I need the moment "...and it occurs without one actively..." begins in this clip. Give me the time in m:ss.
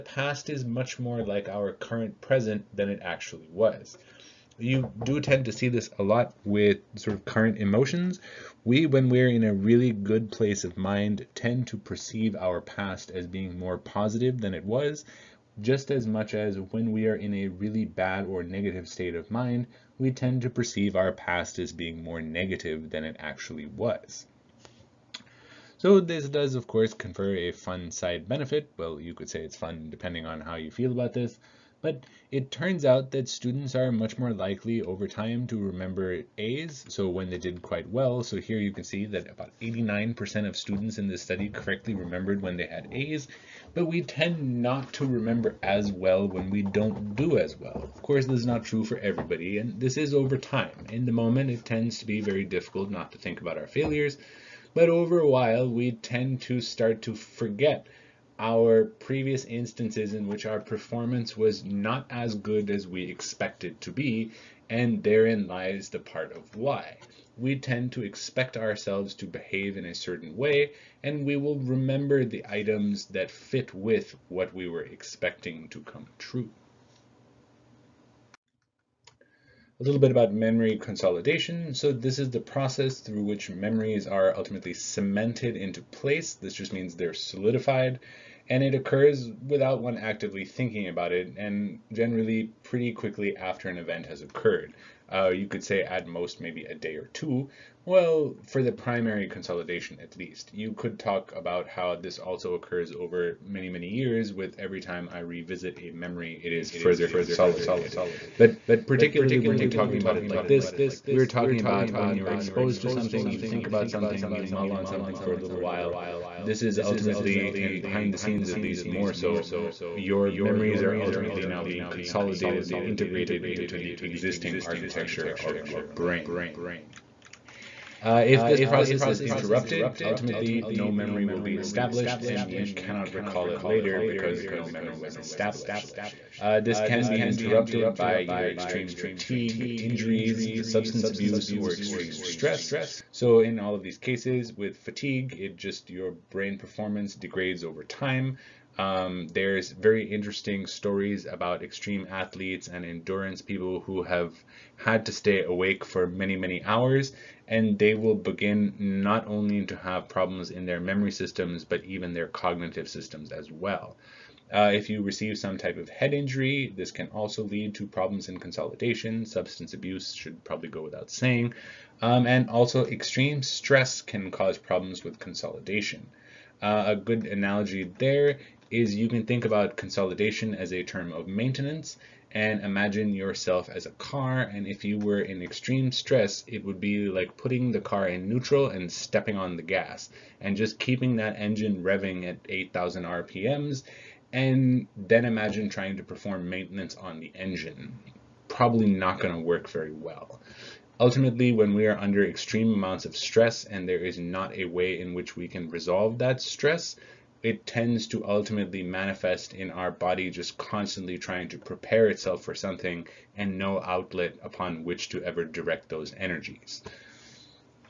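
1:28.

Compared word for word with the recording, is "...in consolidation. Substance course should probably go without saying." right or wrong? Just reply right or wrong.
wrong.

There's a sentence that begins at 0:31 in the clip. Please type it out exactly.
But it turns out that students are much more likely over time to remember A's, so when they did quite well.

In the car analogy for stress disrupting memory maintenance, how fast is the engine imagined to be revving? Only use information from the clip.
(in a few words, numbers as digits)
8000 rpm.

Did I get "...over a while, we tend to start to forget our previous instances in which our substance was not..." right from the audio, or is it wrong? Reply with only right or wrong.
wrong.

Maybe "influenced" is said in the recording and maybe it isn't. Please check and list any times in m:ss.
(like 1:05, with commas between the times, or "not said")
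not said.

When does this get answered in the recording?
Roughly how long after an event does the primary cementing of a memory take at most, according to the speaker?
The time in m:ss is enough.
1:36.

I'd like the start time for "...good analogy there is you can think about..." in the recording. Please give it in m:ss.
2:56.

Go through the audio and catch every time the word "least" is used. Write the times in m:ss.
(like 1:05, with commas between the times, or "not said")
1:40, 1:58.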